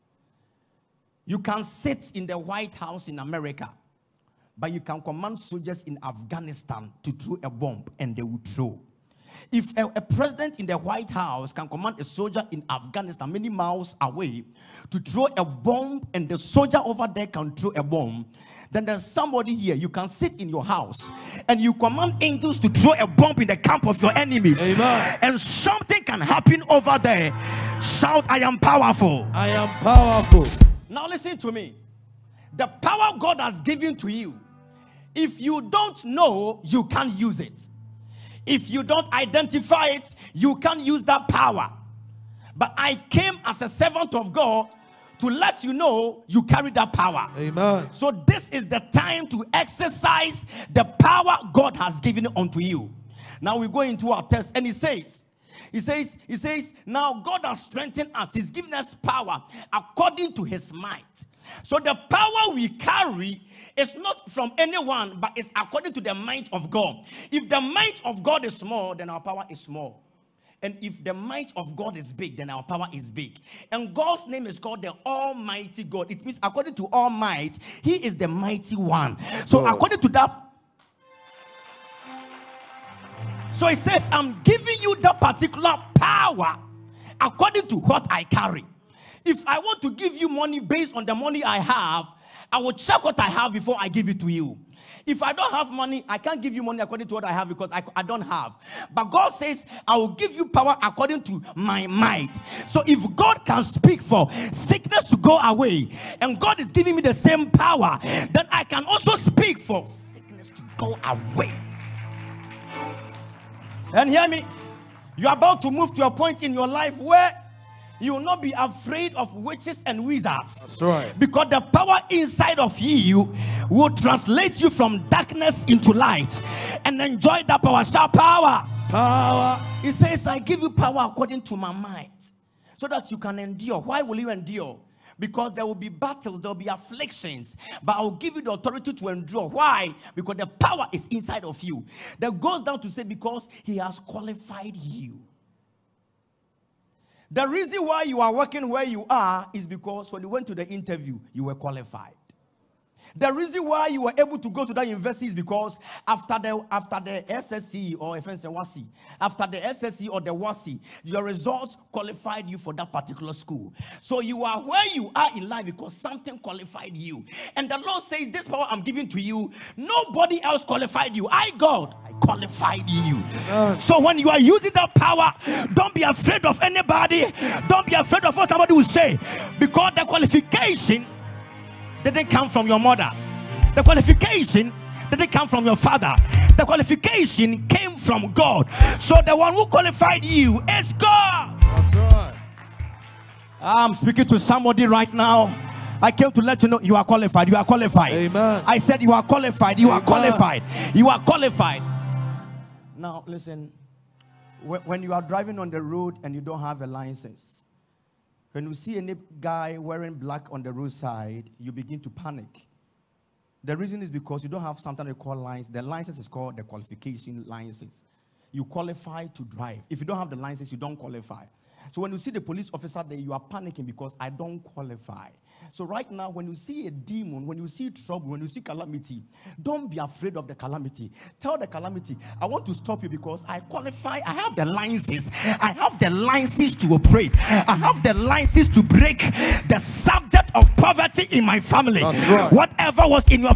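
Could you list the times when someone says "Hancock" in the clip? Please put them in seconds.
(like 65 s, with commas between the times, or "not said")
not said.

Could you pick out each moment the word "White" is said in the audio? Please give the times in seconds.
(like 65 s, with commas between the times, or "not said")
2 s, 10 s.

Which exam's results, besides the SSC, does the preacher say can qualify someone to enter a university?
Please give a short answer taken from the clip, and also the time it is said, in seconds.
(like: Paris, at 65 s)
WASSCE, at 160 s.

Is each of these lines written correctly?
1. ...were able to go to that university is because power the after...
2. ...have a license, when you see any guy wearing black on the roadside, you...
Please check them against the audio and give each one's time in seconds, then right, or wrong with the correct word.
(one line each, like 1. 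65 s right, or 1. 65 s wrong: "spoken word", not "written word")
1. 154 s wrong: "after", not "power"
2. 206 s right.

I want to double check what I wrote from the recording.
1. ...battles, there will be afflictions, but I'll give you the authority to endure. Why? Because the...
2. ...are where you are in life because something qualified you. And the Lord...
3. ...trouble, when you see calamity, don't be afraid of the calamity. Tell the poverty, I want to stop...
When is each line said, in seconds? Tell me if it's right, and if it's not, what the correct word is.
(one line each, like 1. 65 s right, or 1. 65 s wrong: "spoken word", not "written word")
1. 135 s right
2. 164 s right
3. 227 s wrong: "calamity", not "poverty".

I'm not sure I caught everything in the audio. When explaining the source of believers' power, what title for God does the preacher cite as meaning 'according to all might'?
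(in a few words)
Almighty God.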